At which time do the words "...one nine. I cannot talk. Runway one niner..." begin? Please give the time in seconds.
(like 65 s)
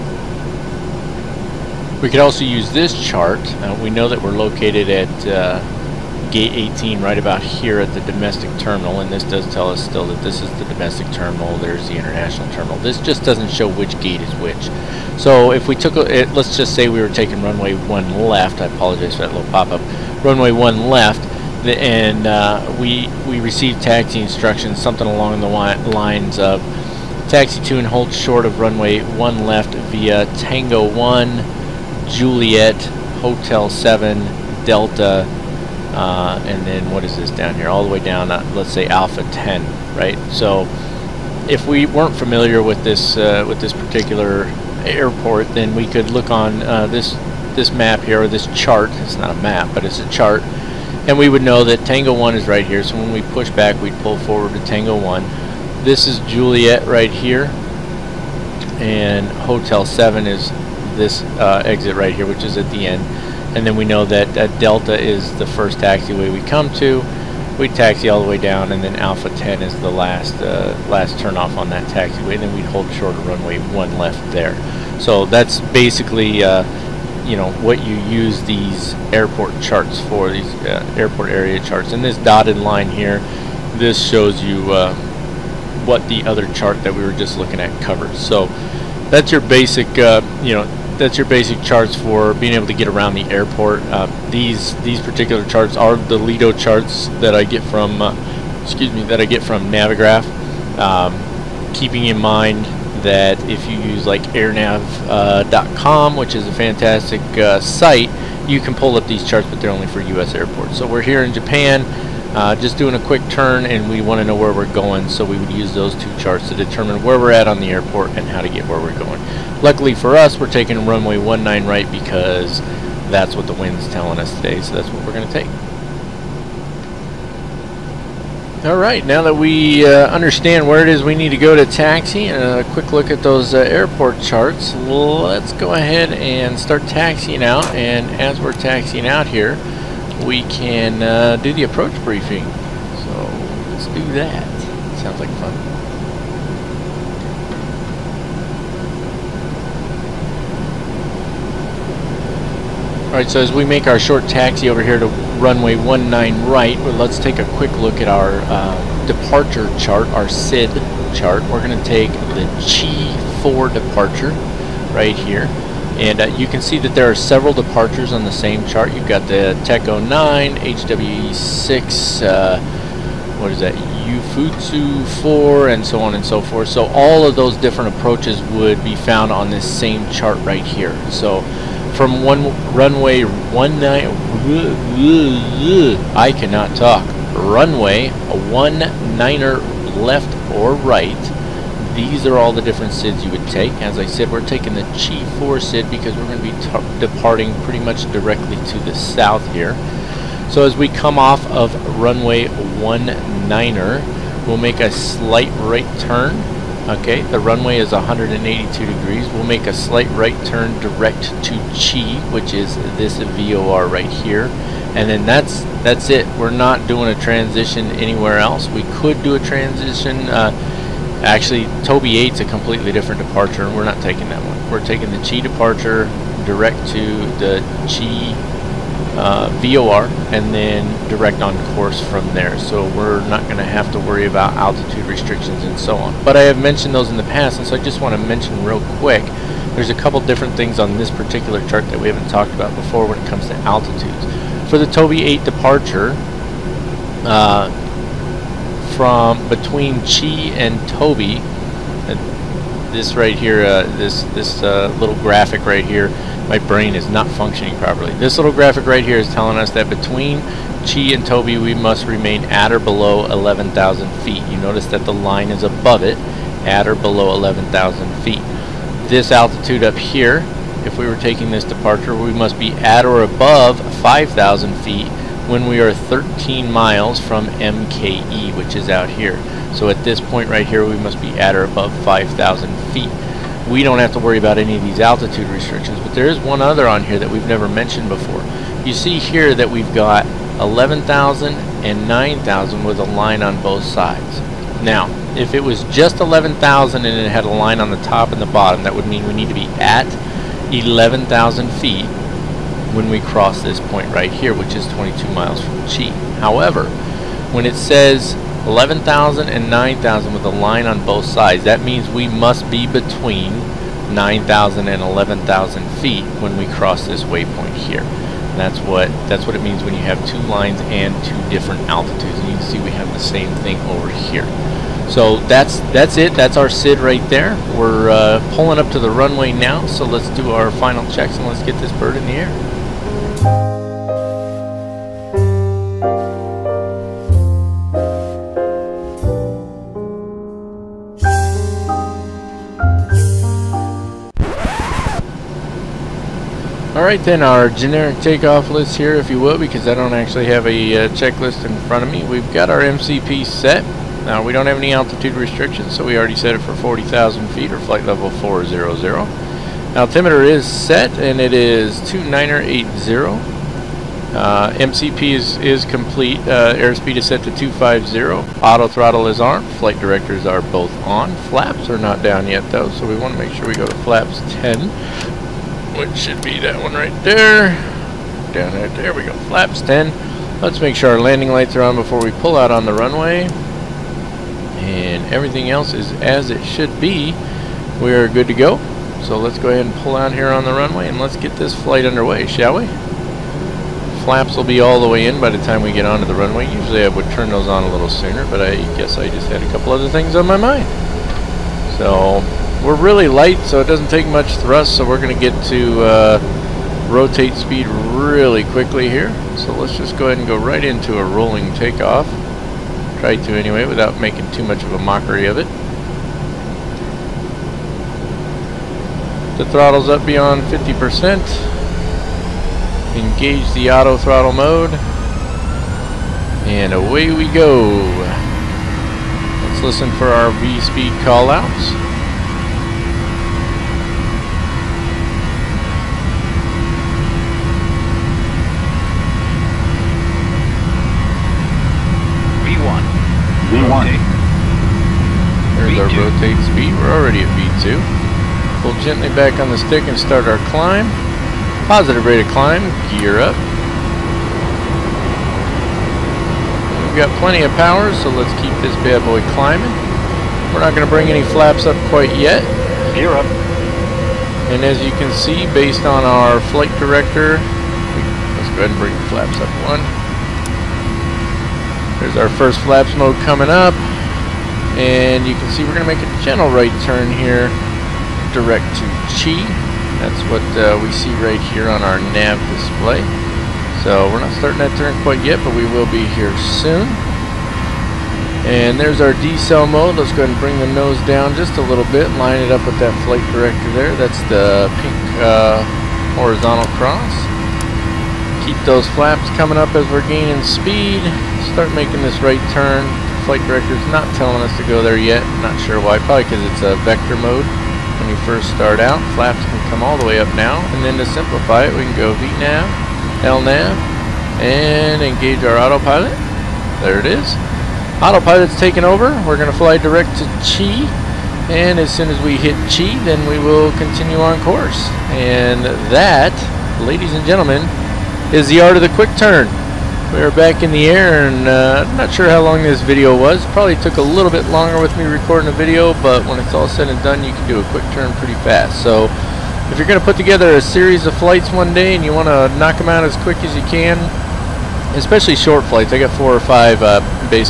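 183 s.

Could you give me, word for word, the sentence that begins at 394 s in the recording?
Flaps will be all the way in by the time we get onto the runway.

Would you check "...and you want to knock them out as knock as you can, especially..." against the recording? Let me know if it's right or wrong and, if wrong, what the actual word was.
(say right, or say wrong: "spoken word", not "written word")
wrong: "quick", not "knock".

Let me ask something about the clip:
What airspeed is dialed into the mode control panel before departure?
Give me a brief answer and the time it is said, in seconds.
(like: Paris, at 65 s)
250, at 367 s.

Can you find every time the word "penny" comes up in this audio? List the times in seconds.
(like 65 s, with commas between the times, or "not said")
not said.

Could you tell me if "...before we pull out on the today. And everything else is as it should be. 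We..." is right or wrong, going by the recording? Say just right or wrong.
wrong.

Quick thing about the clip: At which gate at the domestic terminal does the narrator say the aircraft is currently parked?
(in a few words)
Gate 18.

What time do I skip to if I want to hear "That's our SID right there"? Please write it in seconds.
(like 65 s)
326 s.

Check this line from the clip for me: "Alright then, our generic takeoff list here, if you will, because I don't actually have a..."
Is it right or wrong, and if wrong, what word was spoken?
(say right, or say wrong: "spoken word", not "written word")
right.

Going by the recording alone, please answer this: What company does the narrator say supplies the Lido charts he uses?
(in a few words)
Navigraph.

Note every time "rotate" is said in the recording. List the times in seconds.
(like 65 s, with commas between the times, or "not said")
407 s, 446 s.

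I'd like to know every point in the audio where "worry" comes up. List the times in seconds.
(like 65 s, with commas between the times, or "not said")
233 s, 284 s.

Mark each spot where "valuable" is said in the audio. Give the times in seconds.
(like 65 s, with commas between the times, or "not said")
not said.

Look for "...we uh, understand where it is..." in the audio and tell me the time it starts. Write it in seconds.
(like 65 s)
129 s.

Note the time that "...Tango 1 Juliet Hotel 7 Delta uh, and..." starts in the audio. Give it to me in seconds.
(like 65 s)
30 s.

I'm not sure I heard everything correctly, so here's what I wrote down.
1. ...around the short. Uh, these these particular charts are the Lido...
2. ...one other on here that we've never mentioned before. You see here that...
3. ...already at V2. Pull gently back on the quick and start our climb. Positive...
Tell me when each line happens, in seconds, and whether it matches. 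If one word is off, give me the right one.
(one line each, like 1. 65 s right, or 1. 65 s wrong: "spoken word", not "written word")
1. 92 s wrong: "airport", not "short"
2. 286 s right
3. 447 s wrong: "stick", not "quick".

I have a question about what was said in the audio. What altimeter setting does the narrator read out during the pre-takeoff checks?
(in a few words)
2980.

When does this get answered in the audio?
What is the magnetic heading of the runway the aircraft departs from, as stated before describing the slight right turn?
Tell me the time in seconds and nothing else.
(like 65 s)
207 s.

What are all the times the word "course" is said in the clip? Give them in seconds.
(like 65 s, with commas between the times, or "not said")
231 s, 524 s.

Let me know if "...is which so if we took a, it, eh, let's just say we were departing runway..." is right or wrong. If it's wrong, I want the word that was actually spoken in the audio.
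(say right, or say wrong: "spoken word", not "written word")
wrong: "taking", not "departing".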